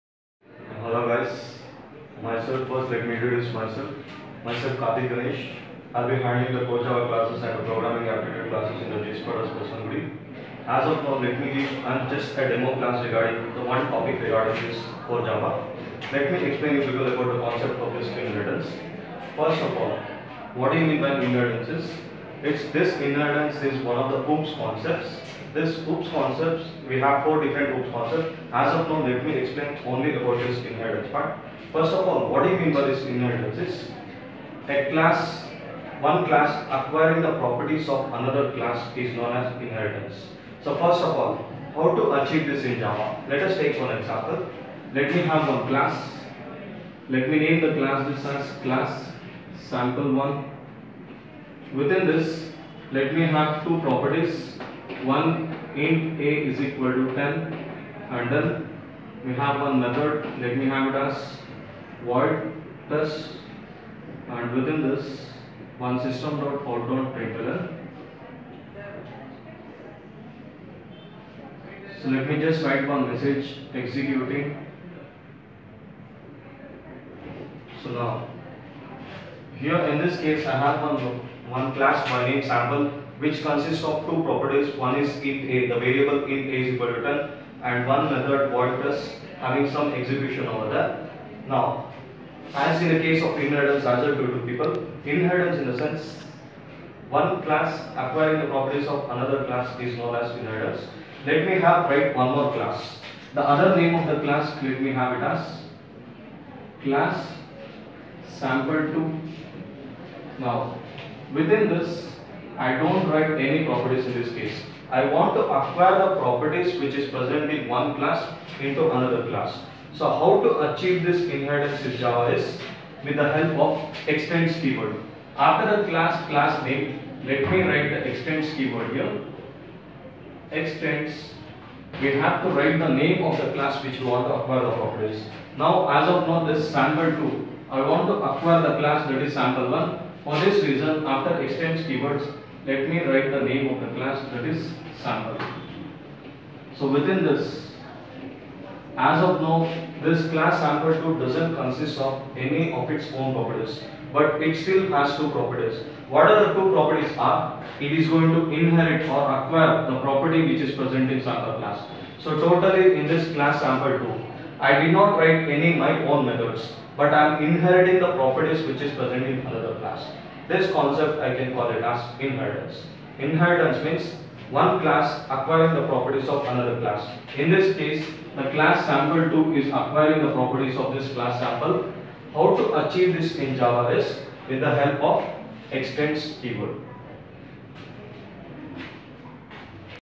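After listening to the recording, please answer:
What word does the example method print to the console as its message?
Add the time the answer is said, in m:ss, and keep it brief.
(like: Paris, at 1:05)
executing, at 1:13.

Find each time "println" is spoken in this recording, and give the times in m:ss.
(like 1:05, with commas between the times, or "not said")
1:07.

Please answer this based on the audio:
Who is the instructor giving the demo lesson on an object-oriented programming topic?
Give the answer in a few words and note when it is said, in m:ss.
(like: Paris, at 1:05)
Karthik Ganesh, at 0:04.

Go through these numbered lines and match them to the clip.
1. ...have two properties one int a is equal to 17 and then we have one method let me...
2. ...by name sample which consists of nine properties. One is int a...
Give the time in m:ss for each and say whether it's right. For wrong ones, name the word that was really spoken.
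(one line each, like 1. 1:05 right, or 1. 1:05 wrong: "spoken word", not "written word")
1. 0:53 wrong: "10", not "17"
2. 1:22 wrong: "two", not "nine".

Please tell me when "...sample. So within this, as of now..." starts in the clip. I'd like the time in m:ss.
2:25.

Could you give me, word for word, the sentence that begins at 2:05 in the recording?
After the class class name, let me write the extends keyword here.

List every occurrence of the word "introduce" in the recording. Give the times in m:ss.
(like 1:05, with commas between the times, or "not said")
0:03.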